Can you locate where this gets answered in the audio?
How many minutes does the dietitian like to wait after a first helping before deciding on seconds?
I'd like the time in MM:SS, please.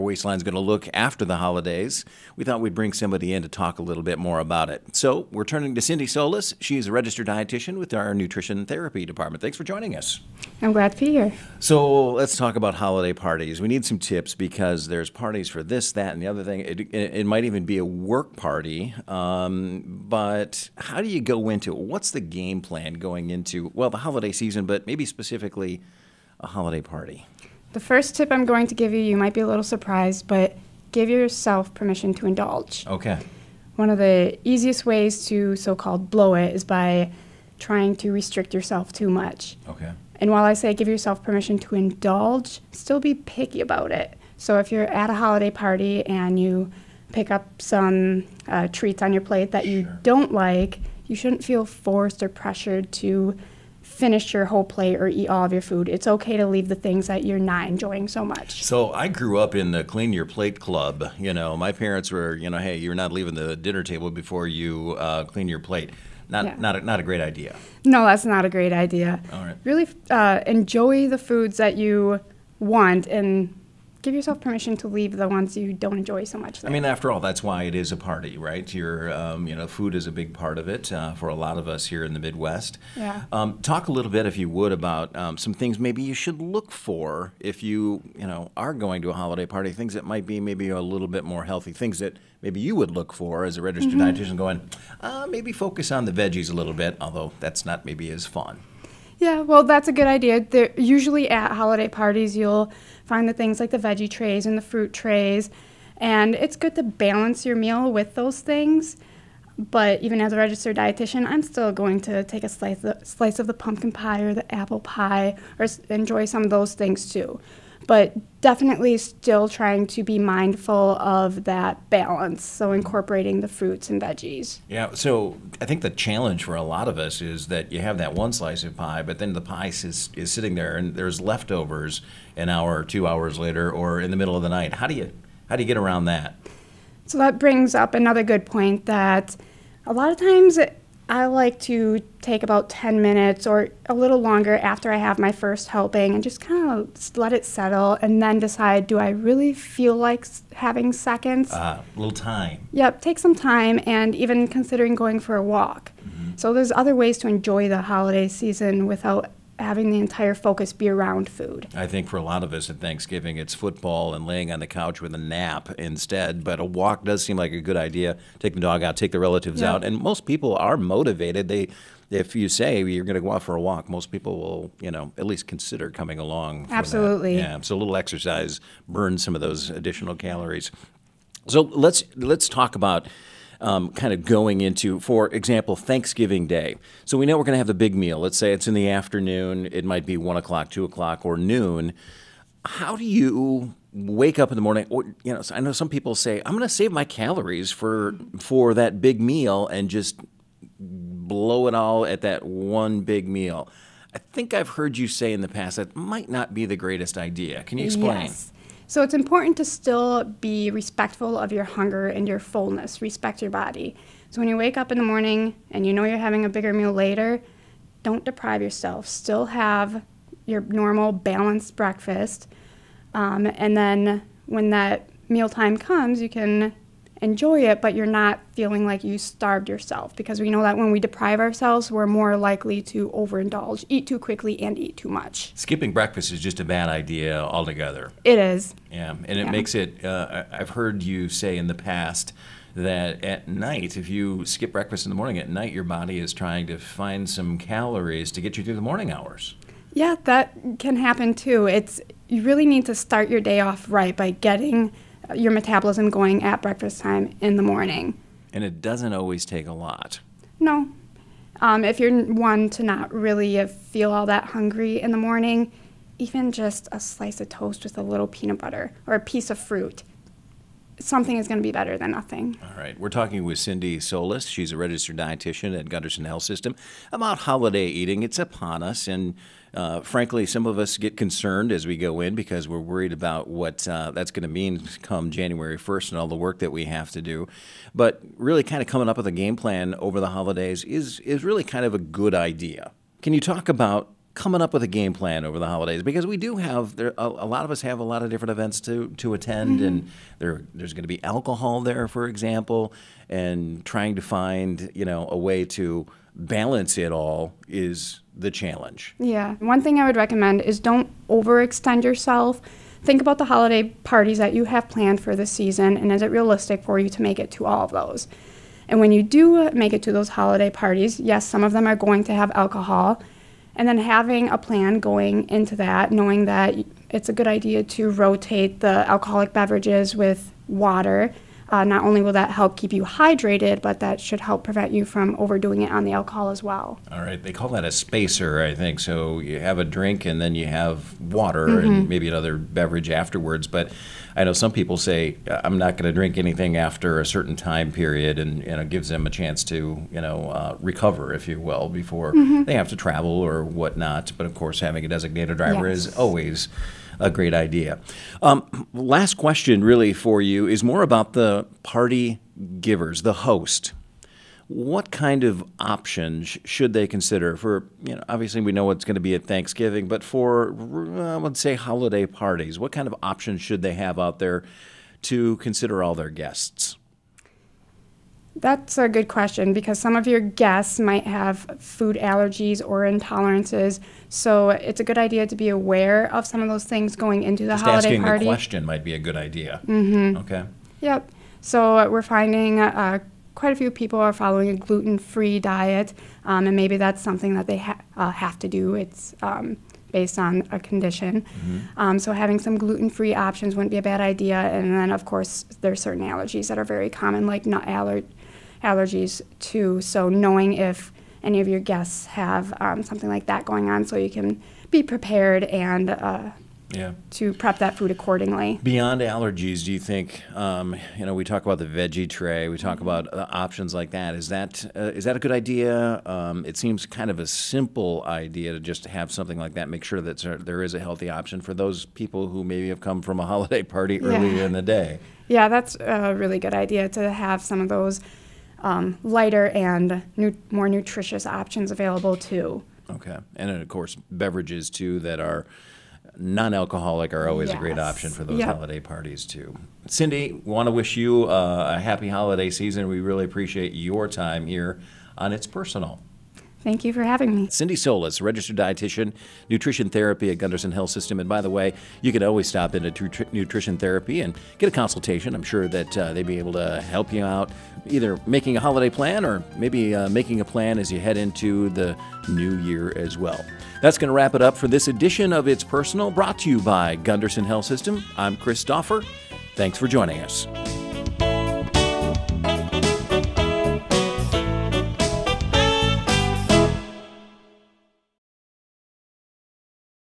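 02:22.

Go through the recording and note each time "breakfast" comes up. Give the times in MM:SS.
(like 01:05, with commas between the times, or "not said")
03:41, 03:55, 04:04, 04:16.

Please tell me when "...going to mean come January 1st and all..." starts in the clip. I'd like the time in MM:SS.
04:44.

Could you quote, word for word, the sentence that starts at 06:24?
So it's a good idea to be aware of some of those things going into the Just holiday asking party.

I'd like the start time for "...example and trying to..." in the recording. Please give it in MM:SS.
05:02.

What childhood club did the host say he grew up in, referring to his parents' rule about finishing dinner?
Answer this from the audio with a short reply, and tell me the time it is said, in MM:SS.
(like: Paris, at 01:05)
clean your plate club, at 00:59.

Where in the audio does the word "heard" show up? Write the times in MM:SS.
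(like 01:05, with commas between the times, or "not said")
03:24, 04:00.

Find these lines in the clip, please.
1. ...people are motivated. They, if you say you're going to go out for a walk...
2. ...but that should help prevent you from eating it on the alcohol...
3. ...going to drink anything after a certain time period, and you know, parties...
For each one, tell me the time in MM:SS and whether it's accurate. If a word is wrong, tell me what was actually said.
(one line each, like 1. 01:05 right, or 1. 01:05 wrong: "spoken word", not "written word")
1. 02:50 right
2. 05:33 wrong: "overdoing", not "eating"
3. 05:45 wrong: "gives", not "parties".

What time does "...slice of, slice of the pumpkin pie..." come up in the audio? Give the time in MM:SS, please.
01:52.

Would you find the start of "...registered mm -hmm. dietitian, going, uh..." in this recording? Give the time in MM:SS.
01:33.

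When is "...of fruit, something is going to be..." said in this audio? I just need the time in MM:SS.
04:29.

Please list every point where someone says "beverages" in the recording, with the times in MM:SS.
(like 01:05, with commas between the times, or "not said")
05:29, 05:42, 07:24.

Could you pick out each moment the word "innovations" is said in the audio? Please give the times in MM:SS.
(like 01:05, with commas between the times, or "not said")
not said.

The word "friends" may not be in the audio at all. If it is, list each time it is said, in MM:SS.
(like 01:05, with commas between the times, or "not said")
not said.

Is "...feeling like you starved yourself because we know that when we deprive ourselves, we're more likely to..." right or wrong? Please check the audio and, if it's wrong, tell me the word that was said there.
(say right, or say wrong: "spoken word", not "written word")
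right.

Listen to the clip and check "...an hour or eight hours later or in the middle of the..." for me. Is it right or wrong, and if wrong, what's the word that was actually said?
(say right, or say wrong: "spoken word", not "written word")
wrong: "two", not "eight".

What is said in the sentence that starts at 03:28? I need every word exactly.
So it's important to still be respectful of your hunger and your fullness.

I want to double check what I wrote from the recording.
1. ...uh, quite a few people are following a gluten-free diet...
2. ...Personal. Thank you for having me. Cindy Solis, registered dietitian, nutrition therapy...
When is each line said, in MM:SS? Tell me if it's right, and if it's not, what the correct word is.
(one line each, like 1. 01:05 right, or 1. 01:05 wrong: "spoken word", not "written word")
1. 06:32 right
2. 07:35 right.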